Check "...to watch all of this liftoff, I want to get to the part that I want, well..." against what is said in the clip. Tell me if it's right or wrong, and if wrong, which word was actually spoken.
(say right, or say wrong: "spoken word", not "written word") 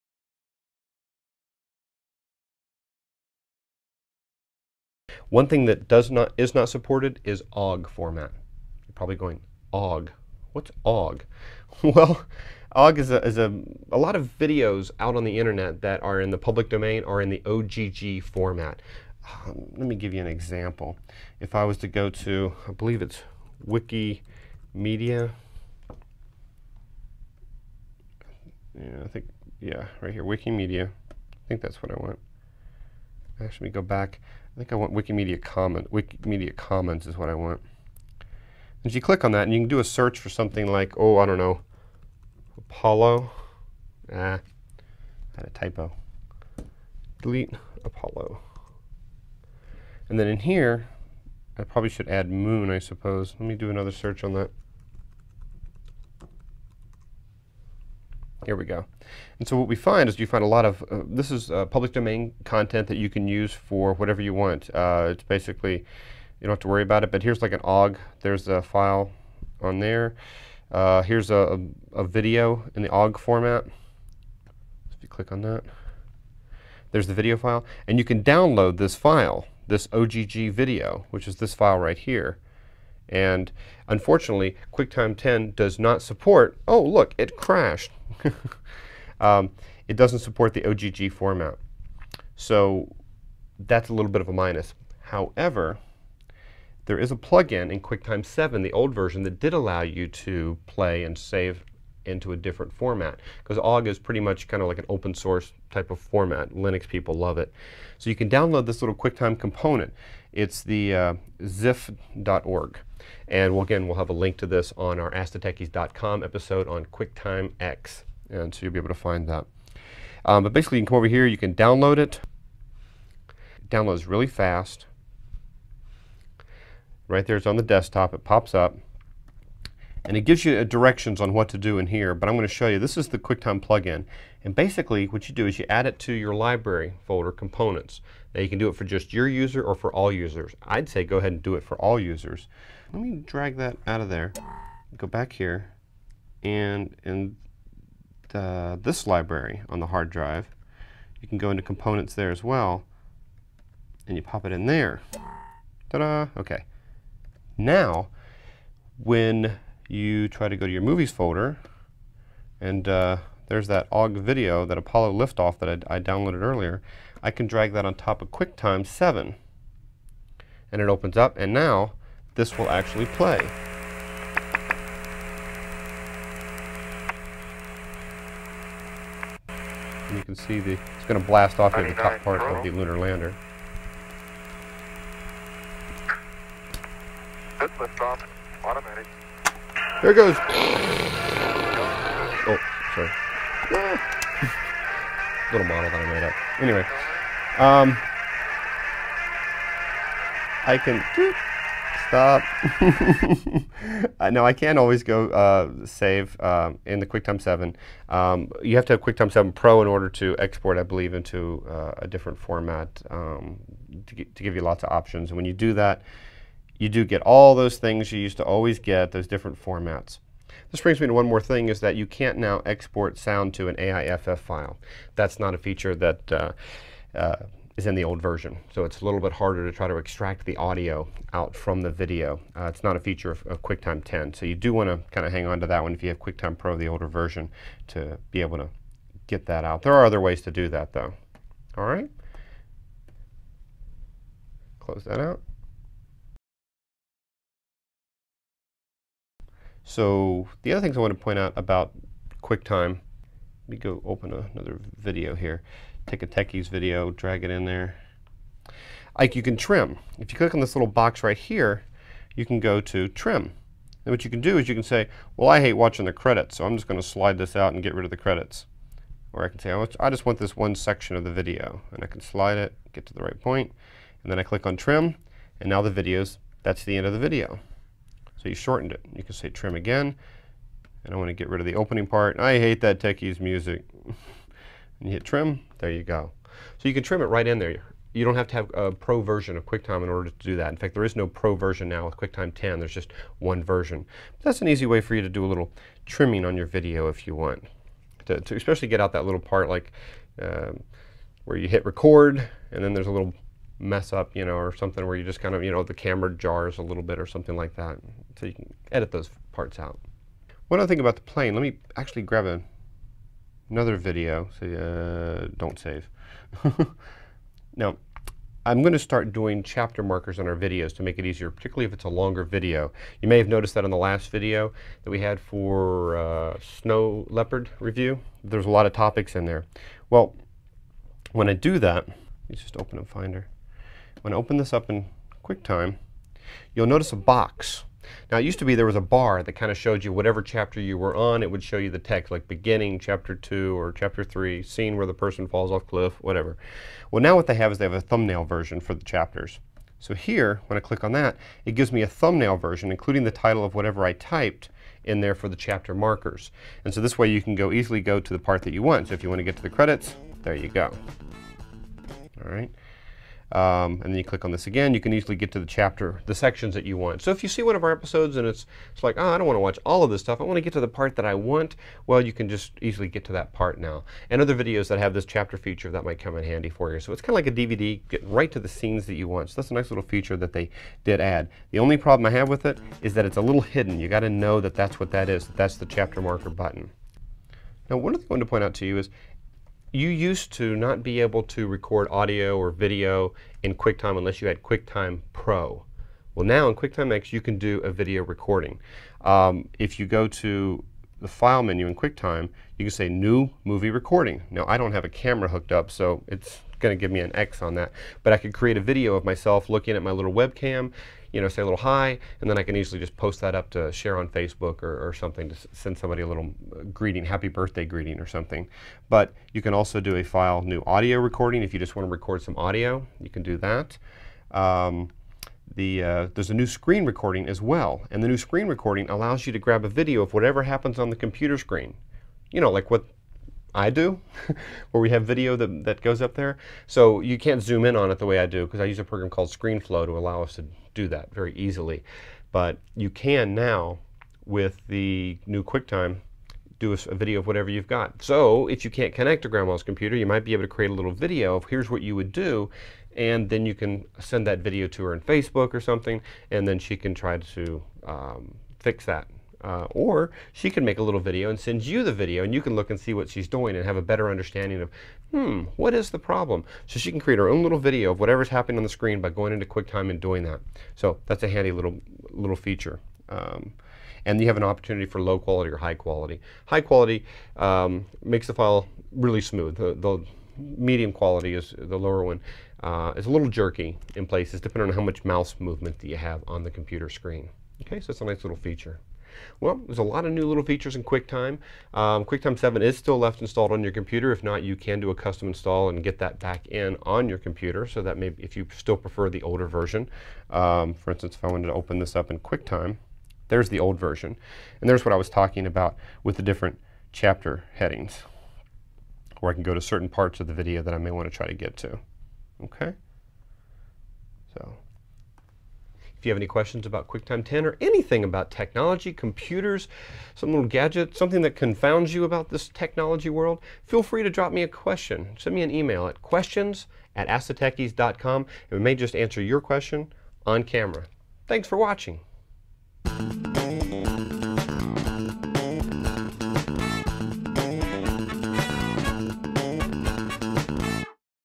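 wrong: "stuff", not "liftoff".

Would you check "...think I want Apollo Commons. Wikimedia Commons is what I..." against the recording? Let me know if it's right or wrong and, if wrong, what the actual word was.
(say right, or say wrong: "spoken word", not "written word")
wrong: "Wikimedia", not "Apollo".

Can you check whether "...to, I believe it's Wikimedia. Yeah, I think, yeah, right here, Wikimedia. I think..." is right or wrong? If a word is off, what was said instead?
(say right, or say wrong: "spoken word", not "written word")
right.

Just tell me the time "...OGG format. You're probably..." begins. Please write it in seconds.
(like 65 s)
7 s.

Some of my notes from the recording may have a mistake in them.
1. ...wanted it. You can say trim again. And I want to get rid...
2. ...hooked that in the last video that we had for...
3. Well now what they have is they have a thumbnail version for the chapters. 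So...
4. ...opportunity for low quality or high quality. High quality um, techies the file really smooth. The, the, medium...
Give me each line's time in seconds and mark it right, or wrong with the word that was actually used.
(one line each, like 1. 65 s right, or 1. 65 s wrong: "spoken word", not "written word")
1. 278 s wrong: "shortened", not "wanted"
2. 323 s wrong: "noticed", not "hooked"
3. 347 s right
4. 474 s wrong: "makes", not "techies".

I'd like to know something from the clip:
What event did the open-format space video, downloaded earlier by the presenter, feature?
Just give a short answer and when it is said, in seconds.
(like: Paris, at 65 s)
Apollo liftoff, at 164 s.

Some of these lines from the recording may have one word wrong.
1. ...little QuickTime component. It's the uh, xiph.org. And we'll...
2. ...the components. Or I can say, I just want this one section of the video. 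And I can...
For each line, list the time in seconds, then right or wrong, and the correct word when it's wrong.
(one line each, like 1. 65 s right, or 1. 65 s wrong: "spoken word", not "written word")
1. 108 s right
2. 268 s wrong: "credits", not "components".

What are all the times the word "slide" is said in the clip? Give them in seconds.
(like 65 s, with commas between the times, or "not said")
267 s, 272 s.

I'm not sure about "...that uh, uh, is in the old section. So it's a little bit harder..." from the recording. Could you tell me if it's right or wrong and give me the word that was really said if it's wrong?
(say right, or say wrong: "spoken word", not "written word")
wrong: "version", not "section".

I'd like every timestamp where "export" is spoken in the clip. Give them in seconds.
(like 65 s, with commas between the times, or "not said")
210 s, 222 s.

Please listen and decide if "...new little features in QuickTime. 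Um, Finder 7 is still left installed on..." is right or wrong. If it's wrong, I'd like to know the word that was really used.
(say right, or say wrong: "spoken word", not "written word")
wrong: "QuickTime", not "Finder".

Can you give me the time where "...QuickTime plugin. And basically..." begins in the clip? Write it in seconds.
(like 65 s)
133 s.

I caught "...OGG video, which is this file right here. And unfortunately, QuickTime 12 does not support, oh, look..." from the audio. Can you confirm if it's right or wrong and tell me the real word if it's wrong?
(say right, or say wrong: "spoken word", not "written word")
wrong: "10", not "12".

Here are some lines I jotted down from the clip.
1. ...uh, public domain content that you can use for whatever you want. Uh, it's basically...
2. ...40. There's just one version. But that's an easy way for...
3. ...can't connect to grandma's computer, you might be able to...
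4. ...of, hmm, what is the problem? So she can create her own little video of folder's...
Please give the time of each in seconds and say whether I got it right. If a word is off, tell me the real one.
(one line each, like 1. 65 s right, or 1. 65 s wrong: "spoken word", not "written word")
1. 61 s right
2. 292 s wrong: "10", not "40"
3. 448 s right
4. 464 s wrong: "whatever", not "folder".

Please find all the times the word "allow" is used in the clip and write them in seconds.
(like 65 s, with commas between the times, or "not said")
99 s, 429 s, 440 s.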